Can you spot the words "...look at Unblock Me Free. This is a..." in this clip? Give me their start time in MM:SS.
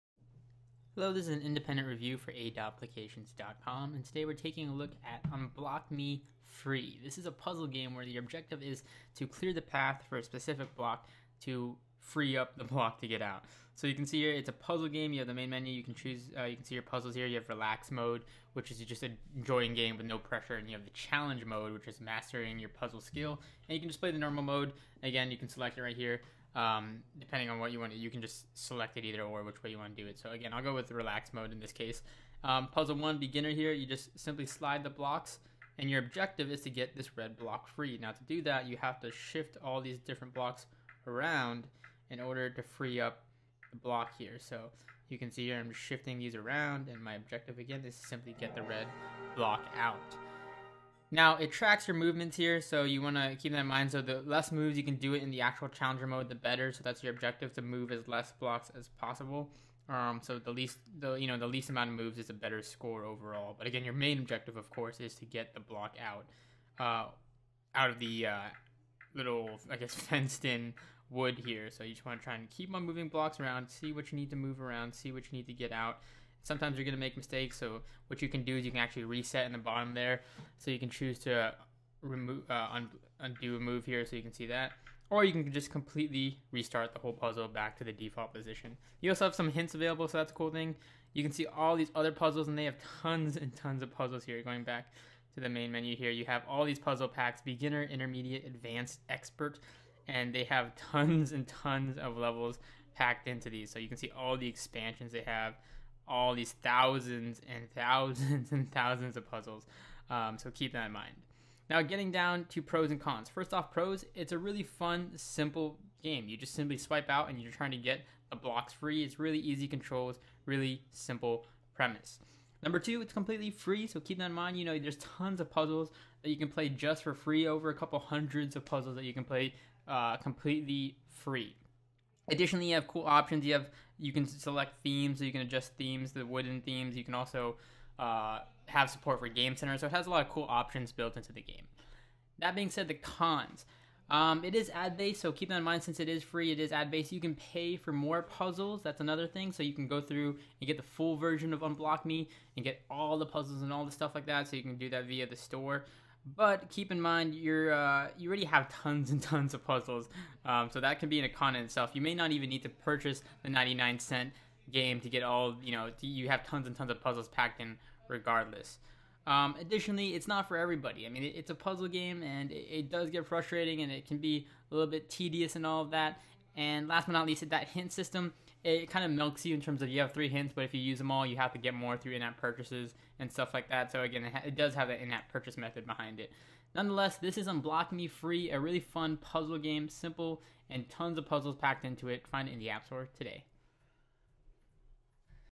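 00:04.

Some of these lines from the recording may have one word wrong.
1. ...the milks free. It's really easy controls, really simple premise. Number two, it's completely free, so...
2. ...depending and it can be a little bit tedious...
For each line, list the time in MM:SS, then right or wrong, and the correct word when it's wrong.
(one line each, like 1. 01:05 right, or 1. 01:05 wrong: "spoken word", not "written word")
1. 01:58 wrong: "blocks", not "milks"
2. 02:53 wrong: "frustrating", not "depending".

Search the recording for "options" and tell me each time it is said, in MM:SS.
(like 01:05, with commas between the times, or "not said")
02:13, 02:20.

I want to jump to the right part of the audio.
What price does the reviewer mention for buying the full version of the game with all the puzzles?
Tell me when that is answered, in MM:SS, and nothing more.
02:43.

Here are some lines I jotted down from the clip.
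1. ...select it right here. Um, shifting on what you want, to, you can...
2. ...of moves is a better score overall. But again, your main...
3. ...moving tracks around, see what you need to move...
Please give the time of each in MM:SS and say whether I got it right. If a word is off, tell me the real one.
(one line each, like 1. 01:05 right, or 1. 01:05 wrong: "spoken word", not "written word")
1. 00:25 wrong: "depending", not "shifting"
2. 01:01 right
3. 01:12 wrong: "blocks", not "tracks".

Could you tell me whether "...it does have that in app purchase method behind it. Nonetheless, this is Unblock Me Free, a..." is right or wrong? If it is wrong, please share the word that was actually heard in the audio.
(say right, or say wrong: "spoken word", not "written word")
right.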